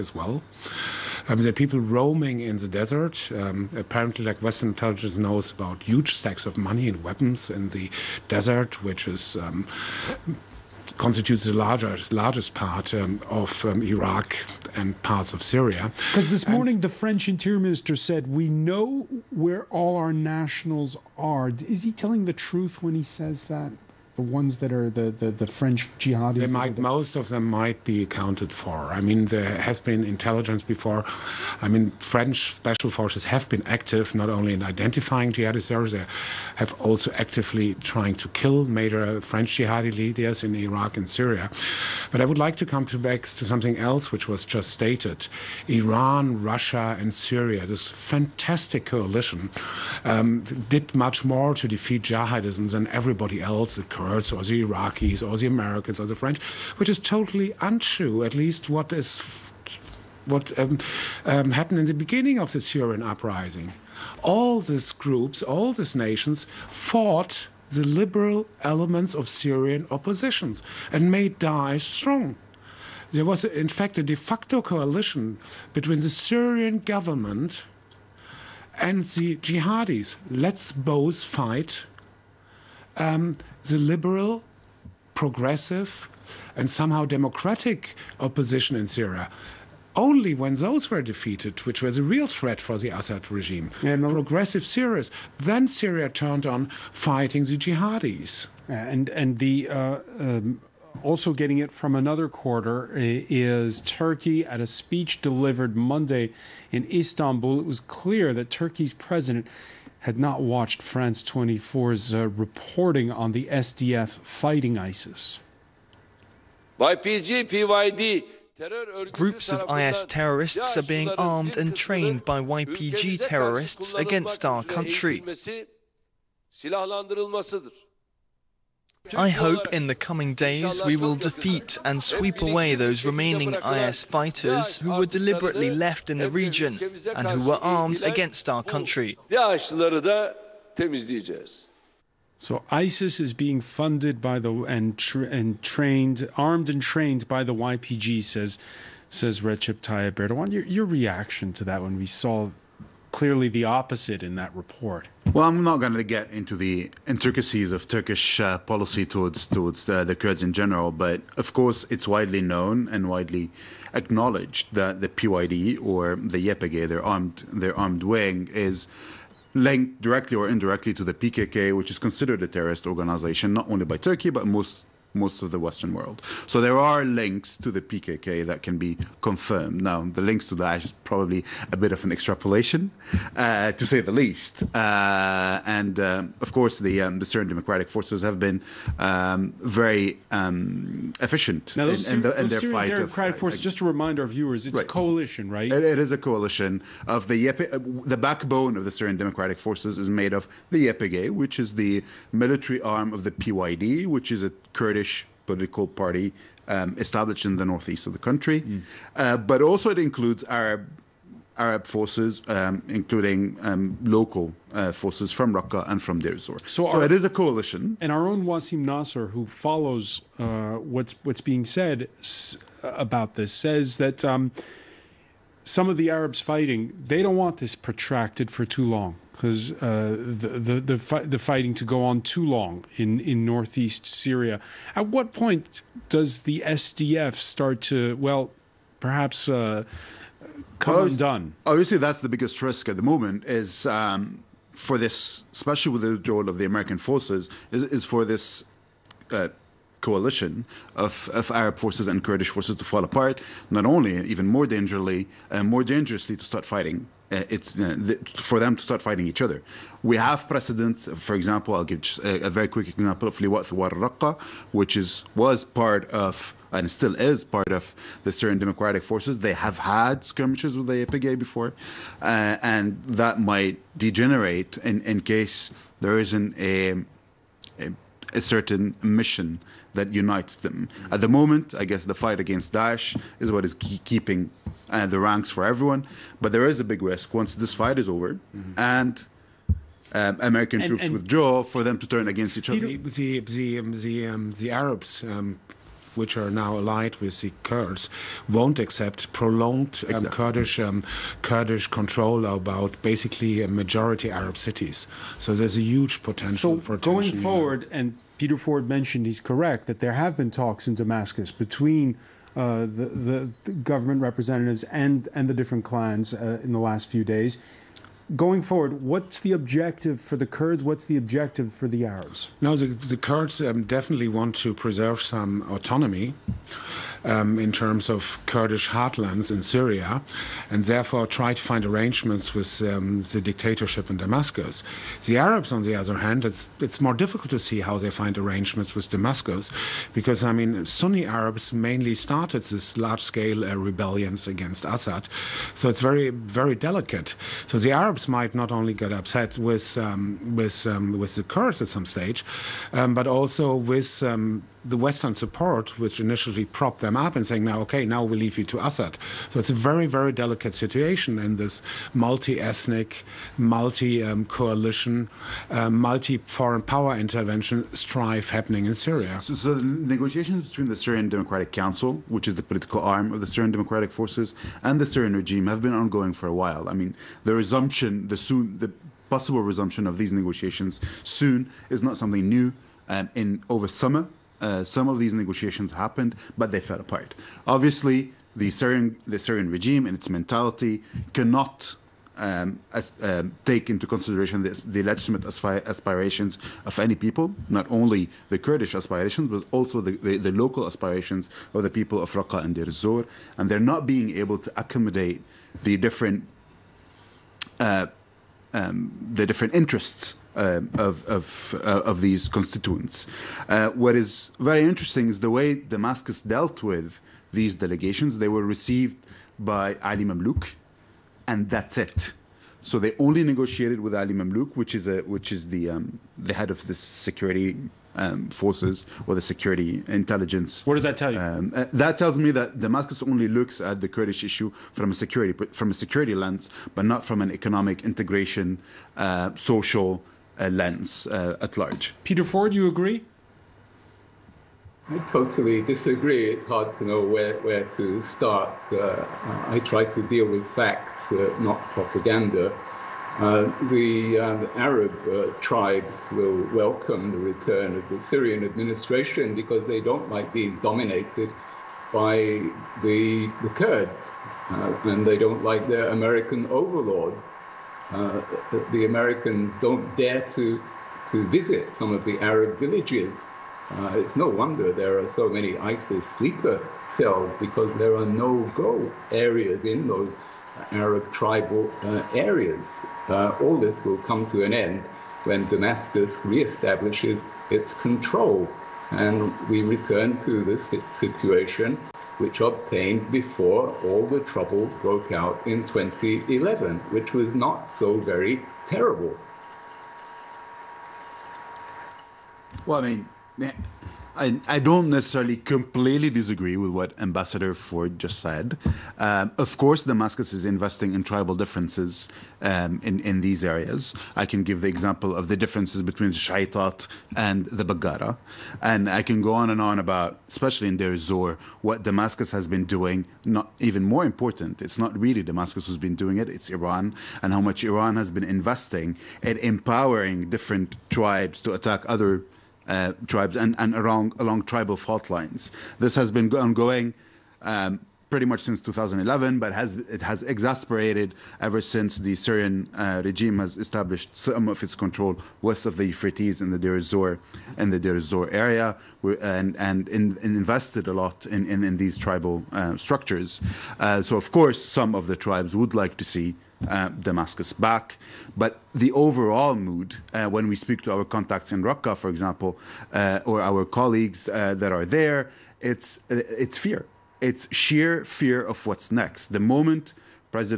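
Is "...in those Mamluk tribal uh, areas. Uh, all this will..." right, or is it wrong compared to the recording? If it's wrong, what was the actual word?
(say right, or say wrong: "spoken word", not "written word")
wrong: "Arab", not "Mamluk".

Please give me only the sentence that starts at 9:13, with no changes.
Uh, so of course, some of the tribes would like to see uh, Damascus back.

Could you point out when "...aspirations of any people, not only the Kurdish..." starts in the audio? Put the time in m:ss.
6:35.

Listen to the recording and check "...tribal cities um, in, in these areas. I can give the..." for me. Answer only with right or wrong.
wrong.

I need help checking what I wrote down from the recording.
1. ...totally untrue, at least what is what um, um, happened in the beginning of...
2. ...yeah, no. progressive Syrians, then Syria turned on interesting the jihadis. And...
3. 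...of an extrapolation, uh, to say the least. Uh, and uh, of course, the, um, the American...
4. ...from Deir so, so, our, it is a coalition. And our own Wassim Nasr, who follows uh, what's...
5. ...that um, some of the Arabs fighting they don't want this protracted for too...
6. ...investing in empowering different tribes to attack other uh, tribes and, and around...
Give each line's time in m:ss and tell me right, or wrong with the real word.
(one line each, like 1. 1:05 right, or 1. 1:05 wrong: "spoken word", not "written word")
1. 0:56 right
2. 1:33 wrong: "fighting", not "interesting"
3. 3:01 wrong: "Syrian", not "American"
4. 3:36 right
5. 3:43 right
6. 8:48 right.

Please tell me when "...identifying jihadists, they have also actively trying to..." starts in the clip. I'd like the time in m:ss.
0:34.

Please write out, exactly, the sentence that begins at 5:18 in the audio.
Going forward, what's the objective for the Kurds?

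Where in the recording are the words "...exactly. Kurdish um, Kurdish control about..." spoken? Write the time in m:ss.
5:00.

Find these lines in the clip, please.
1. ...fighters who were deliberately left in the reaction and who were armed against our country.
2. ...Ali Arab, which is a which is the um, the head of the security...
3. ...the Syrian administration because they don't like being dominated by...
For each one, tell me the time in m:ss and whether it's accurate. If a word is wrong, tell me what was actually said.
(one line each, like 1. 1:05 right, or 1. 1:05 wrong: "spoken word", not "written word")
1. 2:14 wrong: "region", not "reaction"
2. 7:04 wrong: "Mamluk", not "Arab"
3. 7:38 right.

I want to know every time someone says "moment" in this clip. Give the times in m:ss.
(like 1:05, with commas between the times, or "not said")
4:03, 4:41, 9:29.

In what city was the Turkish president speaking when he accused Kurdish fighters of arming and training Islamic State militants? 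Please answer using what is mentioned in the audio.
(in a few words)
Istanbul.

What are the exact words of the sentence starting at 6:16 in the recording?
I mean, the resumption, the soon, the possible resumption of these negotiations soon is not something new.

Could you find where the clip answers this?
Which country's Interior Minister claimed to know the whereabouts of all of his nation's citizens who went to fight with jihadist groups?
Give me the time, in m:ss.
0:16.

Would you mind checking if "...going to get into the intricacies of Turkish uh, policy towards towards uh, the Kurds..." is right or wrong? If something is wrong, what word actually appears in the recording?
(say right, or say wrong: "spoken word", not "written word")
right.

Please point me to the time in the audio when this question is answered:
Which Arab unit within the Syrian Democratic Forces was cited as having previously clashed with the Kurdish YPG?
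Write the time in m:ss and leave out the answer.
4:23.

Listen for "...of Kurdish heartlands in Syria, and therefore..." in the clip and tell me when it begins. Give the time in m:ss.
5:28.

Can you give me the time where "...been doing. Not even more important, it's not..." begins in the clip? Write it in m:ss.
8:42.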